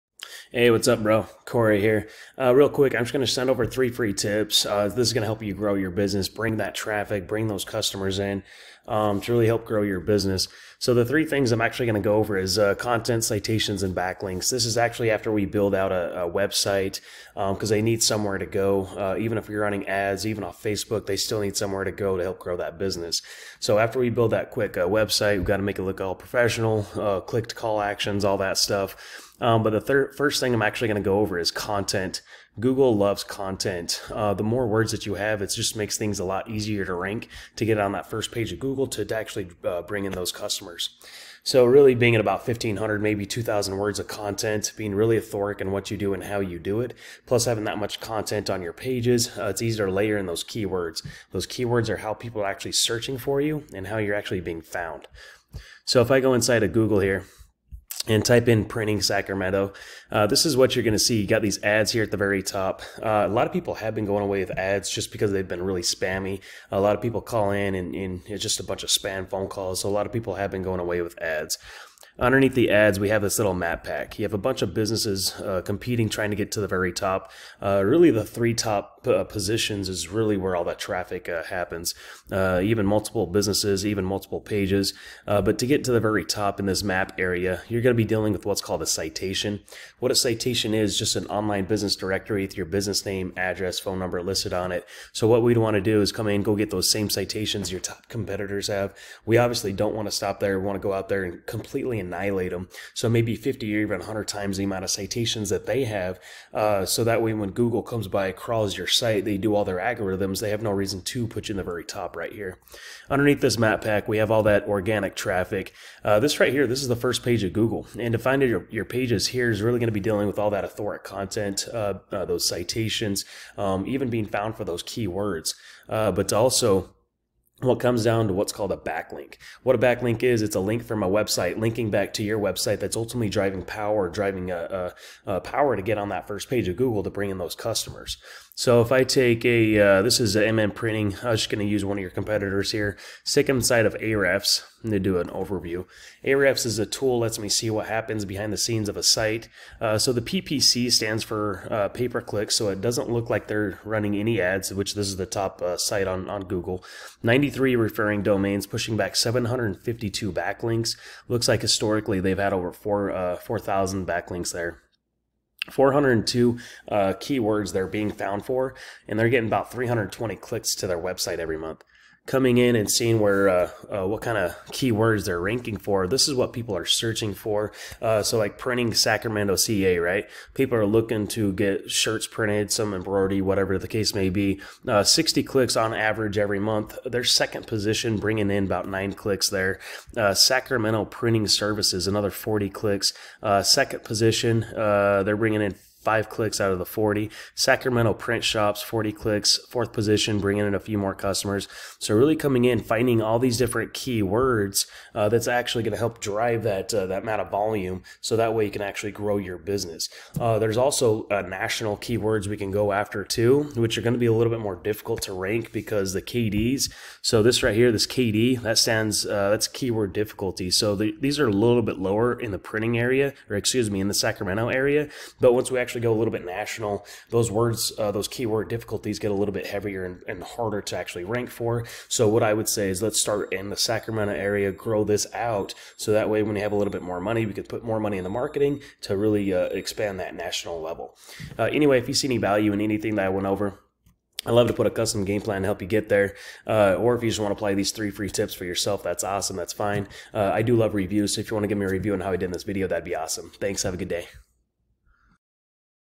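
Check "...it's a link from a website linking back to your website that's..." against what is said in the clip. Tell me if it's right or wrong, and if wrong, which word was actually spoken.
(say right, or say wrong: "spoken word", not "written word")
right.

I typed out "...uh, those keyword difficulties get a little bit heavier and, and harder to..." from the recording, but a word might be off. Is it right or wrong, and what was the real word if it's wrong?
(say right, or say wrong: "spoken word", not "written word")
right.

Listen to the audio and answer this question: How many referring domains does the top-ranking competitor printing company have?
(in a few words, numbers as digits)
93.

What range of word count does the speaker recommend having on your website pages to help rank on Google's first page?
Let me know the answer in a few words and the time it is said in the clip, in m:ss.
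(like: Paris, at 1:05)
1500 to 2000 words, at 0:42.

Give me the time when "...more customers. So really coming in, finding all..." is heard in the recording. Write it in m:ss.
3:20.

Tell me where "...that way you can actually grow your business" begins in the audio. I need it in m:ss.
3:28.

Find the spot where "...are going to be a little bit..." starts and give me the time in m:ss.
3:33.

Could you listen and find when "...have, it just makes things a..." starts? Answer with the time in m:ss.
0:35.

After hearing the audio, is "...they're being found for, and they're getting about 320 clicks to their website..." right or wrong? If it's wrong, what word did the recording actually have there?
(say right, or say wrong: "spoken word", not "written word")
right.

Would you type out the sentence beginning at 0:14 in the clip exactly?
This is actually after we build out a, a website because um, they need somewhere to go.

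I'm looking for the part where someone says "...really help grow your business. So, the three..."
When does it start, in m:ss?
0:09.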